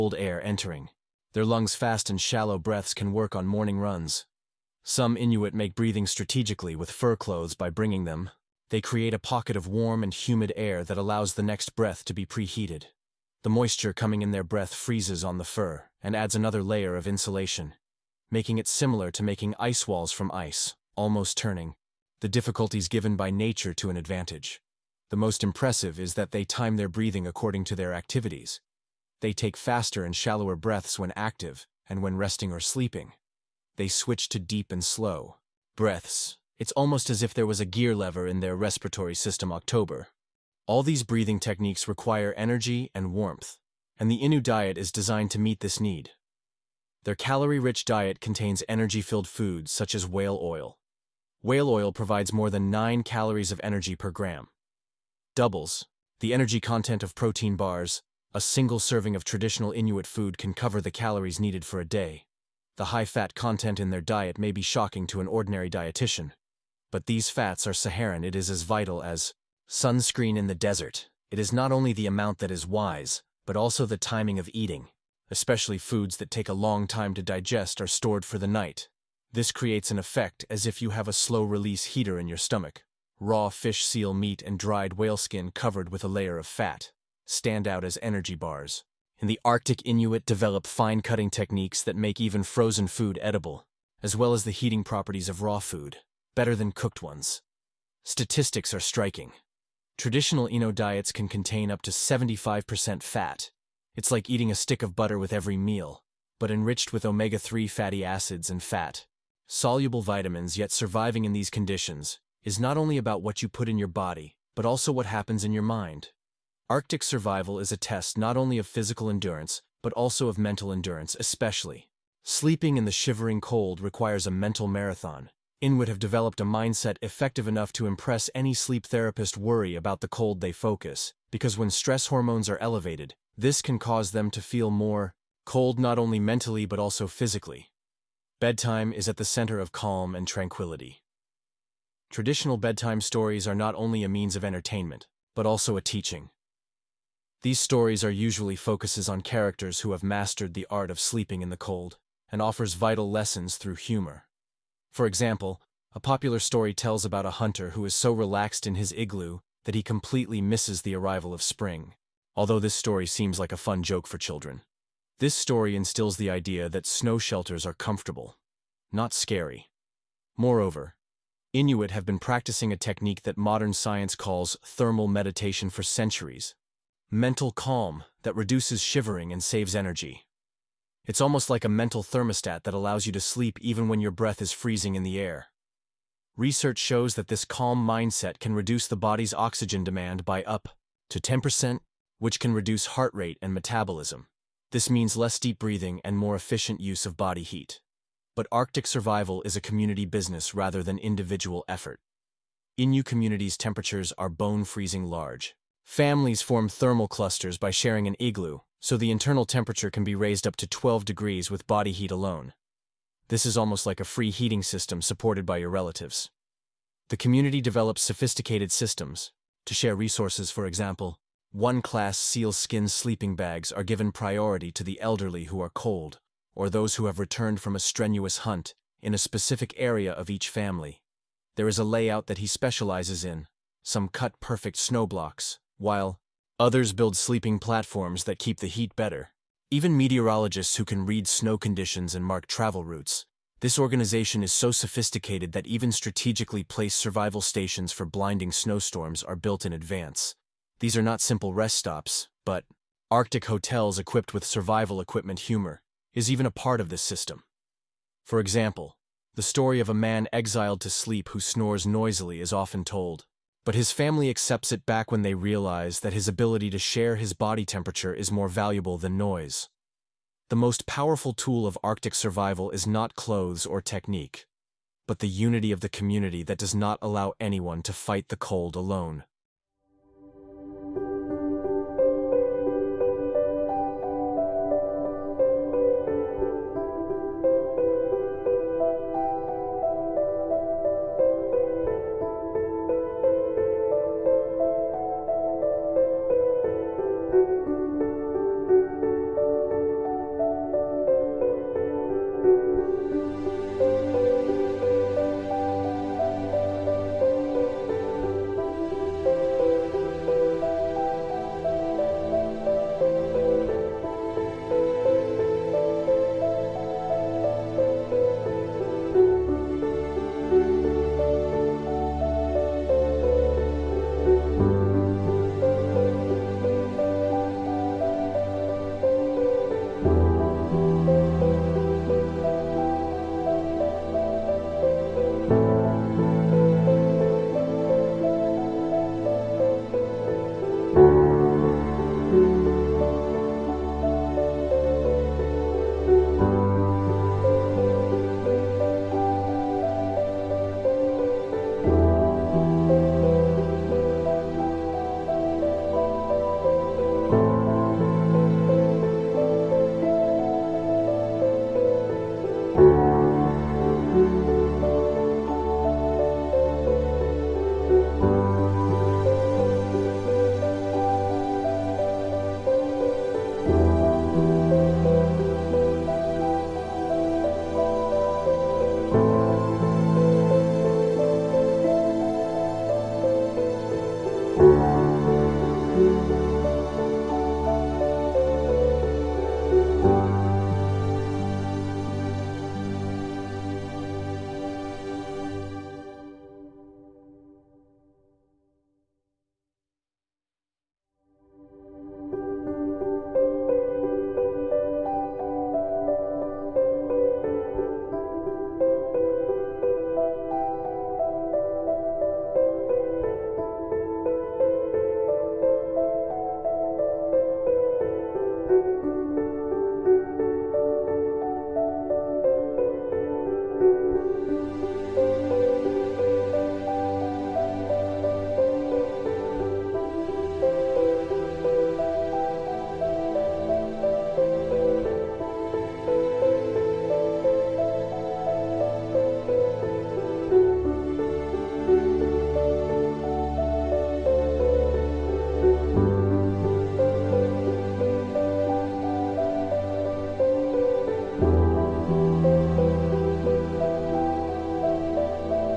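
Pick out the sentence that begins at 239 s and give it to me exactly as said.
Even meteorologists who can read snow conditions and mark travel routes.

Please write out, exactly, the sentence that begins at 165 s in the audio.
This story instills the idea that snow shelters are comfortable, not scary.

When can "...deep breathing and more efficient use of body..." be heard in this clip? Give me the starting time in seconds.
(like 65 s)
195 s.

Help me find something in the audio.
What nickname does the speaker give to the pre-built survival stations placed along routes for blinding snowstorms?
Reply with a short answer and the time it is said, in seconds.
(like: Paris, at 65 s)
Arctic hotels, at 253 s.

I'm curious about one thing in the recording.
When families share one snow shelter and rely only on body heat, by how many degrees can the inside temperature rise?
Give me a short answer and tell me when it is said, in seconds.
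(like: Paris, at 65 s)
12 degrees, at 210 s.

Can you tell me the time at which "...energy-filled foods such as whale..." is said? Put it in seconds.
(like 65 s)
48 s.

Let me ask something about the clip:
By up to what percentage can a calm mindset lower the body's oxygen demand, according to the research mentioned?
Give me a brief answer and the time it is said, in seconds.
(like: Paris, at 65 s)
10%, at 191 s.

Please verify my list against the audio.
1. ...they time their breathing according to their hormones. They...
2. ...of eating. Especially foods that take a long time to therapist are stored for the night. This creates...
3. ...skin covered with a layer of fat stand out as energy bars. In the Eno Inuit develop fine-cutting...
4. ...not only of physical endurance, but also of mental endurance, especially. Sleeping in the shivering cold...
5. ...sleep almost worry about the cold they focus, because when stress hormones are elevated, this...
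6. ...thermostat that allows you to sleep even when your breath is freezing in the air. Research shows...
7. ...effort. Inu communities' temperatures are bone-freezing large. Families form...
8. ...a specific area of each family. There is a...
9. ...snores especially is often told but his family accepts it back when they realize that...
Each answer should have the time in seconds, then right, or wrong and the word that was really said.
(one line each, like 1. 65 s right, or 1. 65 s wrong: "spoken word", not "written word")
1. 26 s wrong: "activities", not "hormones"
2. 74 s wrong: "digest", not "therapist"
3. 85 s wrong: "Arctic", not "Eno"
4. 118 s right
5. 128 s wrong: "therapist", not "almost"
6. 182 s right
7. 201 s right
8. 229 s right
9. 261 s wrong: "noisily", not "especially".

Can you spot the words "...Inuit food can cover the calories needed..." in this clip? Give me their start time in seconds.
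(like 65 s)
59 s.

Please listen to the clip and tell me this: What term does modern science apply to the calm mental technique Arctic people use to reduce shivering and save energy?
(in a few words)
thermal meditation.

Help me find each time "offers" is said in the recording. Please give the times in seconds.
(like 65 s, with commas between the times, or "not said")
152 s.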